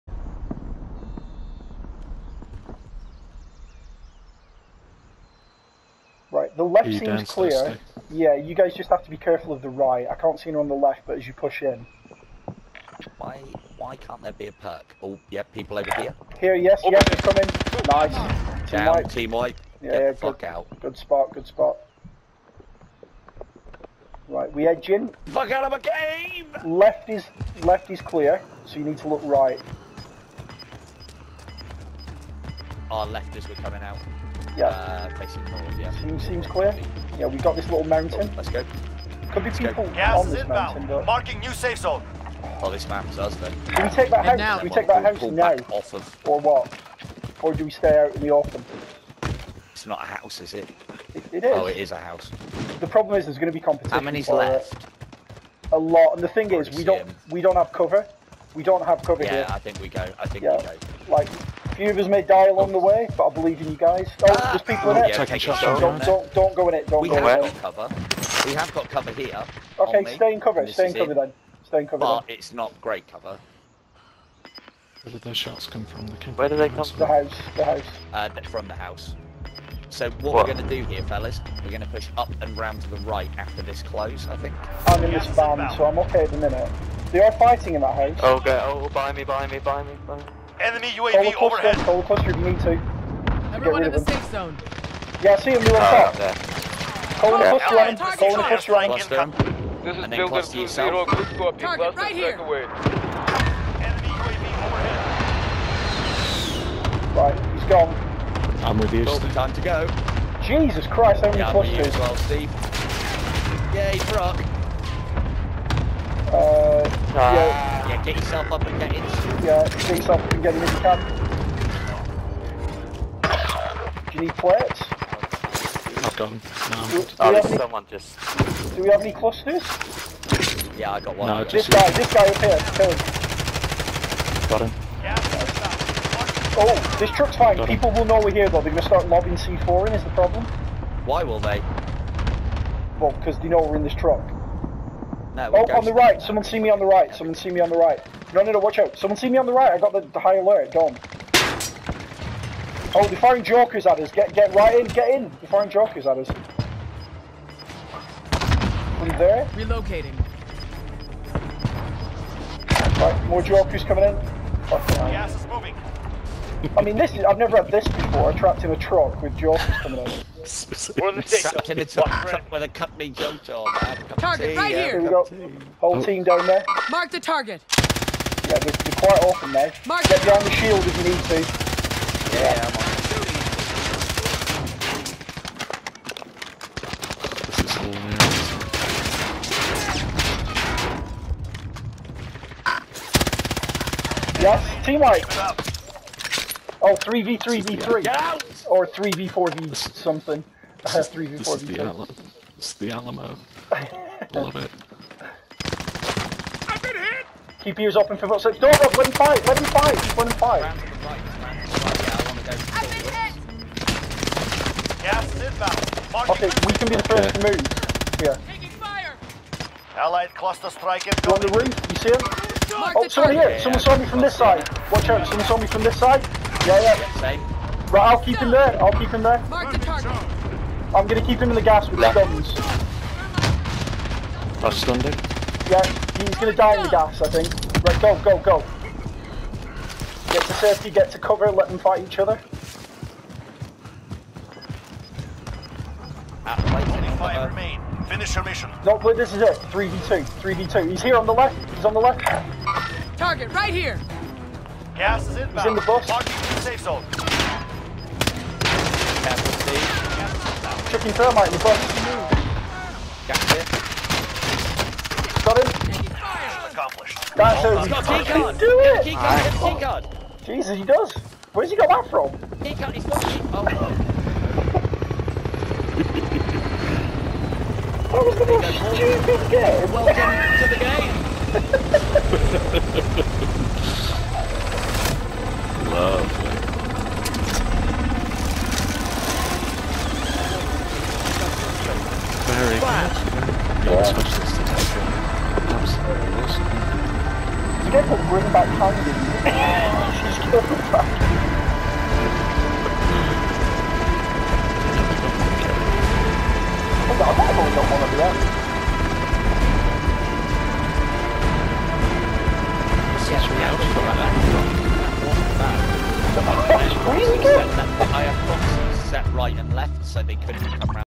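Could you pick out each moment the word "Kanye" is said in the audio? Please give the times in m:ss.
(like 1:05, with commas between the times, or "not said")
4:58.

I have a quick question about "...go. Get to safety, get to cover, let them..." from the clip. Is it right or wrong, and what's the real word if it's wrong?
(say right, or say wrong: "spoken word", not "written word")
right.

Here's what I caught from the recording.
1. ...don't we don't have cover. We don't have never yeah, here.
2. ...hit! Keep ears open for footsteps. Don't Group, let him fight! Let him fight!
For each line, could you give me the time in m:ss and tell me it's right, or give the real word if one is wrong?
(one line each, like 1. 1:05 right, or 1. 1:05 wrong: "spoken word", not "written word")
1. 0:56 wrong: "cover", not "never"
2. 3:26 wrong: "Rob", not "Group".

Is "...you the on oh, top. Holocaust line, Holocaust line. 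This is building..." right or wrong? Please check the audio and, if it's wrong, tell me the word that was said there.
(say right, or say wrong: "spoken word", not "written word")
right.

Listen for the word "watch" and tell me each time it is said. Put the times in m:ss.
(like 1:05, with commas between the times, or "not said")
2:28, 3:44.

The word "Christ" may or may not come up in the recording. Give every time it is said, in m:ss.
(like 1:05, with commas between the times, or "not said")
1:50.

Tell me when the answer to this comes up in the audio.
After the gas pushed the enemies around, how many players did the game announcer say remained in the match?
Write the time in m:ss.
4:07.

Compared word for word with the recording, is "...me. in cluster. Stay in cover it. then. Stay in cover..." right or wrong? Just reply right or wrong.
wrong.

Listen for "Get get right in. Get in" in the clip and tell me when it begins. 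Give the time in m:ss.
2:34.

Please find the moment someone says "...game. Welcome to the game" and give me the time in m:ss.
4:39.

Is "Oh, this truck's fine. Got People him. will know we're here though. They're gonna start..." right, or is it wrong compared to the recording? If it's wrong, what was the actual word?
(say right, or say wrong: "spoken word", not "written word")
right.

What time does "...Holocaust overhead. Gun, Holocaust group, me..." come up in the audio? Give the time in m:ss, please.
1:31.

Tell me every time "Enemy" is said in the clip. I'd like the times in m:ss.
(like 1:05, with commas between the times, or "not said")
1:30, 1:42.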